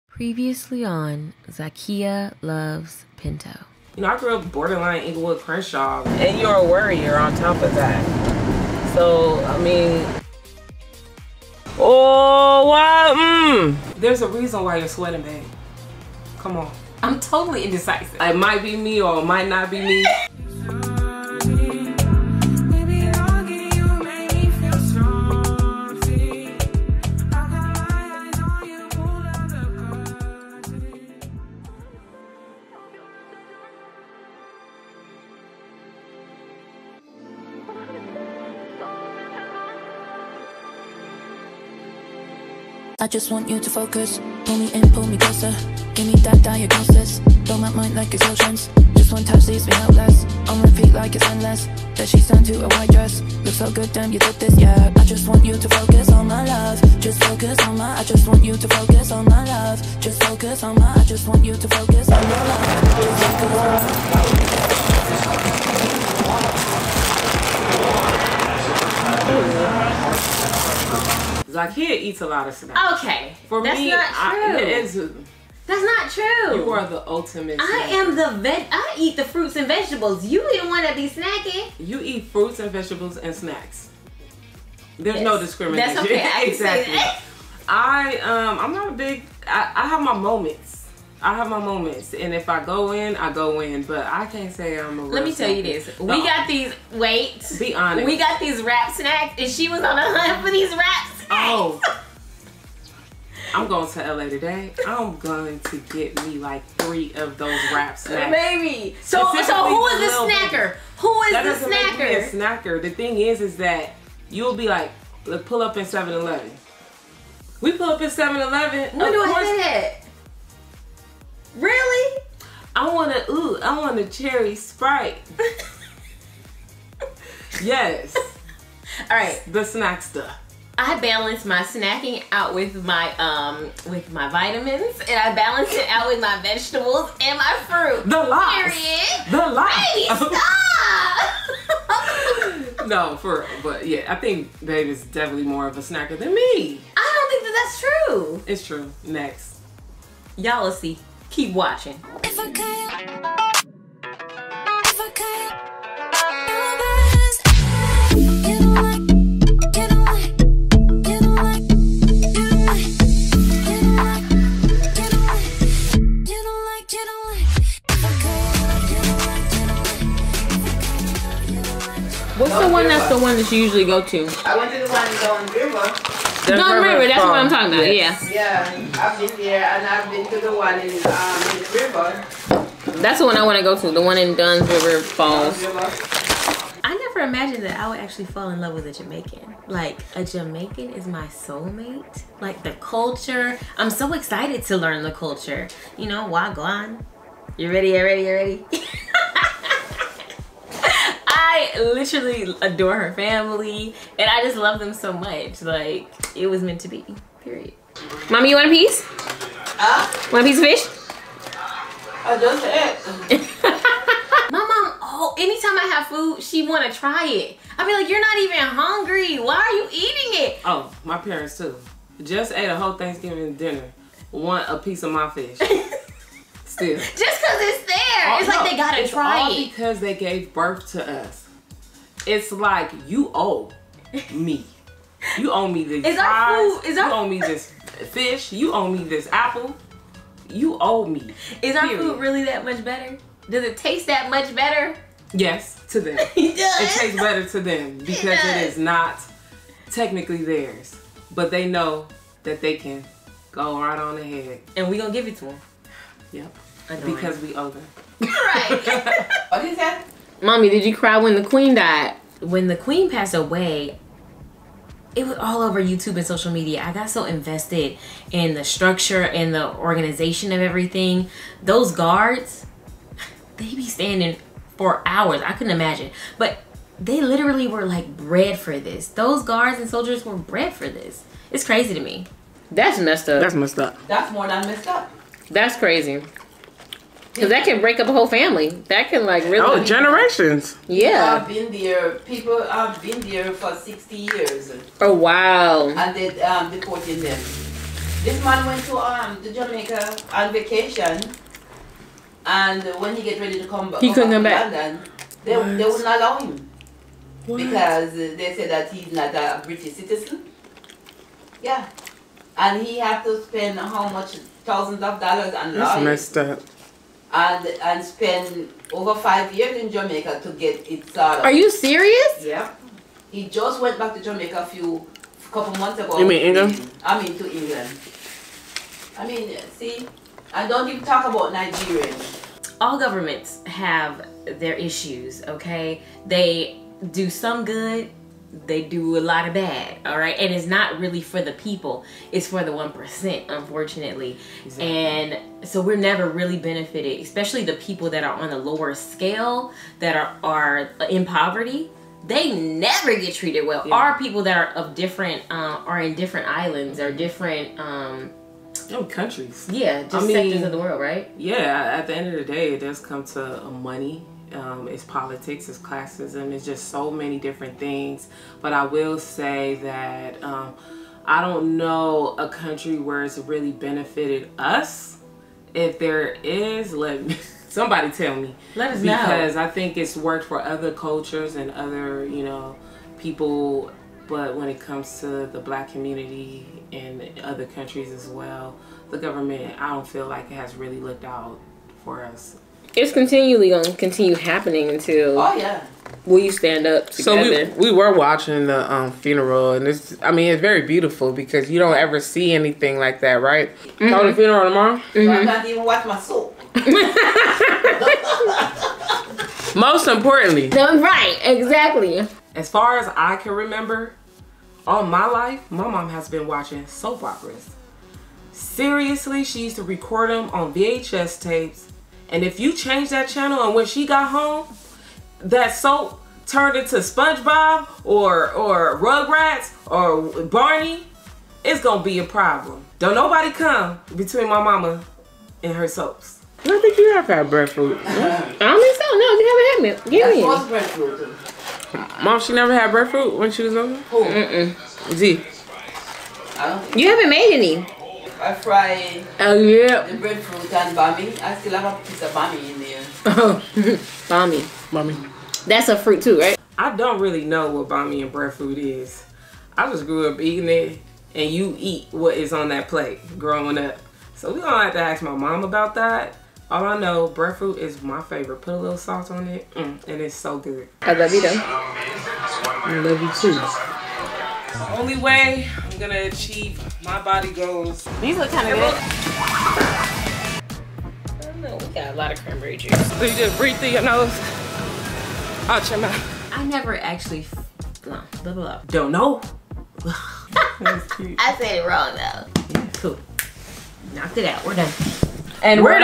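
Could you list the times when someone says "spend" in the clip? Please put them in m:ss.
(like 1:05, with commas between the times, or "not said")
5:13, 5:18.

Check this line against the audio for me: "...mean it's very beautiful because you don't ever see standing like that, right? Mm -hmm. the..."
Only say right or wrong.
wrong.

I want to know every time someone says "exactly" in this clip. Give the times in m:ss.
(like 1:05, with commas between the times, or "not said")
1:26, 5:44, 6:51.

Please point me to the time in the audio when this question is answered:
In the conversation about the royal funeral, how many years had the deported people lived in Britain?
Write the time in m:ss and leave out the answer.
4:53.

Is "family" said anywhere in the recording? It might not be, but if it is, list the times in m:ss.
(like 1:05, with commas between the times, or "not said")
3:23, 4:48.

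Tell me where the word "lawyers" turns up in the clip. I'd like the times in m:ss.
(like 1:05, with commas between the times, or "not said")
5:15.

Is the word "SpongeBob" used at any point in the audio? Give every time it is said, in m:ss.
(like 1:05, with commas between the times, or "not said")
7:06.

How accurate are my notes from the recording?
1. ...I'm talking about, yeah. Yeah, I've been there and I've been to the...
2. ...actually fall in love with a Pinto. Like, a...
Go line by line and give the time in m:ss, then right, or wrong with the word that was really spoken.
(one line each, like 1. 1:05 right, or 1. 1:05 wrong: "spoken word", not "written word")
1. 2:57 right
2. 3:07 wrong: "Jamaican", not "Pinto".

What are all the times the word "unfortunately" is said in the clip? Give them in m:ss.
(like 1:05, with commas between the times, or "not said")
5:43.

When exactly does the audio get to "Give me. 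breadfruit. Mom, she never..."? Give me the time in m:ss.
7:20.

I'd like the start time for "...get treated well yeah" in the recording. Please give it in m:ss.
5:53.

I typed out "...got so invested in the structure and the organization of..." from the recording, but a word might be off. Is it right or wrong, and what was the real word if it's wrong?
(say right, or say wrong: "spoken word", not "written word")
right.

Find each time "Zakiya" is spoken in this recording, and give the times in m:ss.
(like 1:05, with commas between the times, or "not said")
0:01, 1:11.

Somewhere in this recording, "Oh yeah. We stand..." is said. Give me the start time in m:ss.
6:35.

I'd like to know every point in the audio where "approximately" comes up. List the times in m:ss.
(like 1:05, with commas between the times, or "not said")
not said.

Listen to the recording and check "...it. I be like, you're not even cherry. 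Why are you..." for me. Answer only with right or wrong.
wrong.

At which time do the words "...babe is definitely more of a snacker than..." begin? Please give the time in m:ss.
2:24.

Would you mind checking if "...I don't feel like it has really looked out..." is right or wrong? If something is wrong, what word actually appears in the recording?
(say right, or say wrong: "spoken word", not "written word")
right.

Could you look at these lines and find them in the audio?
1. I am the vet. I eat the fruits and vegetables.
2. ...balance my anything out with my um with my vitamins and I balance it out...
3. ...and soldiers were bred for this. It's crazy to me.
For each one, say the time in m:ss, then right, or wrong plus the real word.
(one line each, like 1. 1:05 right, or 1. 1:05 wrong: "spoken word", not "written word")
1. 1:17 right
2. 2:10 wrong: "snacking", not "anything"
3. 4:39 right.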